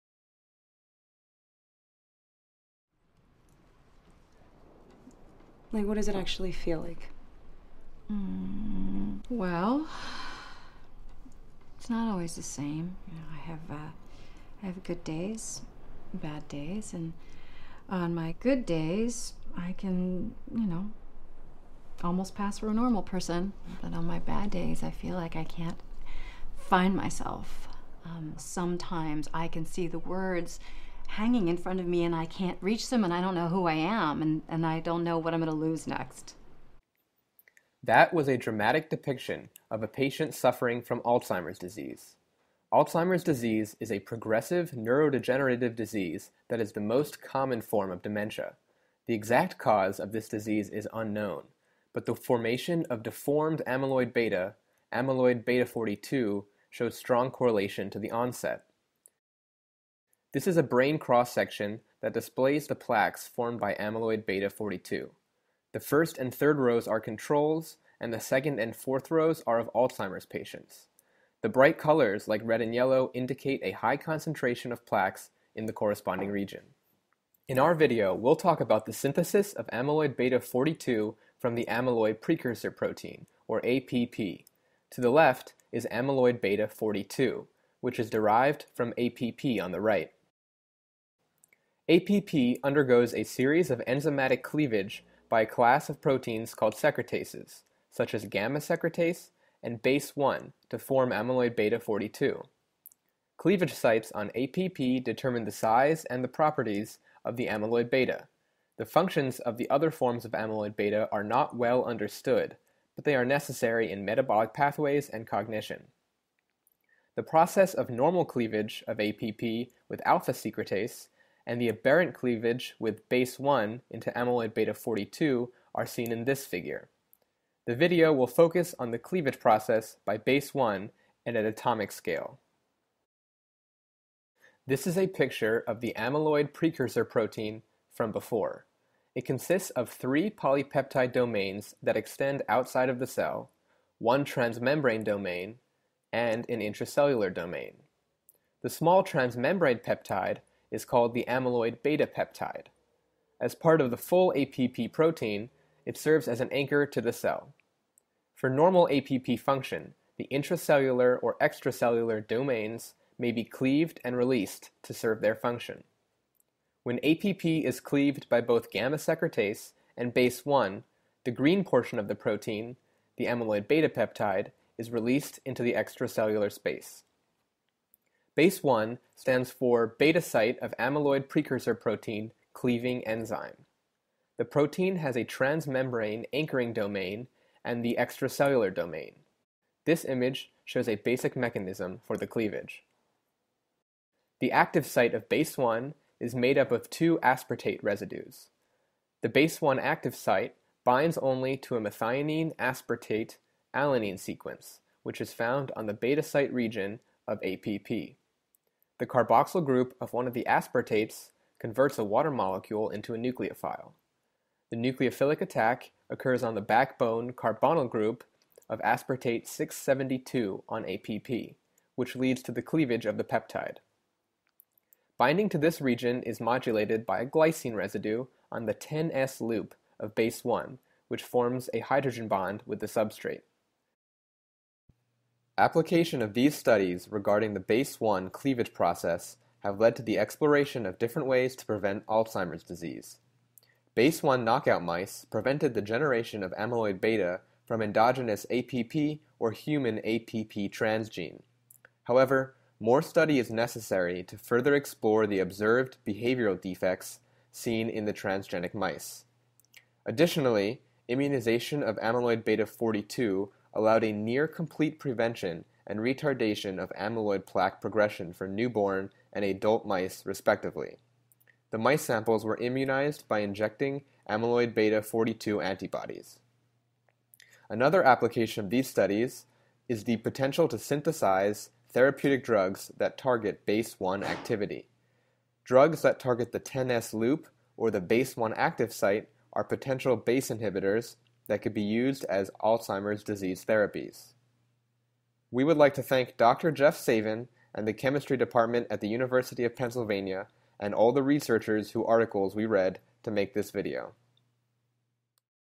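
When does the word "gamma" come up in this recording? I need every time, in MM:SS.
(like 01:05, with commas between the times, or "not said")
01:38, 02:48.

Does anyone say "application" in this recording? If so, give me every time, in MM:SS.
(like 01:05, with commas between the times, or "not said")
03:55, 04:38.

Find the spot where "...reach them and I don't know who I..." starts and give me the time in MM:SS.
00:32.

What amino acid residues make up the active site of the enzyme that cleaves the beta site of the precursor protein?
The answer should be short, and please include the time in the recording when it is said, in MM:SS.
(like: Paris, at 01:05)
two aspartate residues, at 03:16.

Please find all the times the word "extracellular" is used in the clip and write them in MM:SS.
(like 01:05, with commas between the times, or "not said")
02:41, 02:55, 03:07.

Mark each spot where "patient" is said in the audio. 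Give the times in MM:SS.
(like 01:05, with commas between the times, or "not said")
00:39, 01:10.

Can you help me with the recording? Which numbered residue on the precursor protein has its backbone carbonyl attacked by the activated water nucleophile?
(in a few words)
aspartate 672.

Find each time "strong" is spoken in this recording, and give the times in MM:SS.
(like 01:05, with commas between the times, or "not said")
00:56.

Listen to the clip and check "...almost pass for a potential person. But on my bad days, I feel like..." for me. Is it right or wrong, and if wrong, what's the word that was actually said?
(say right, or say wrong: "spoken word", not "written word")
wrong: "normal", not "potential".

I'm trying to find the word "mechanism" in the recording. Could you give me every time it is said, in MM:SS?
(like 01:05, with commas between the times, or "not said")
03:11.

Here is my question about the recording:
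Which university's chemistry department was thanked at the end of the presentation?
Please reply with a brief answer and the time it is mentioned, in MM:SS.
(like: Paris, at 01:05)
University of Pennsylvania, at 04:59.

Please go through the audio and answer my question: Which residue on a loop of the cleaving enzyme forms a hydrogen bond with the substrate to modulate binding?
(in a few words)
glycine.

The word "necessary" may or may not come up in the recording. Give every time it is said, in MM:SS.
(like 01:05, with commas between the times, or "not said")
01:53, 04:13.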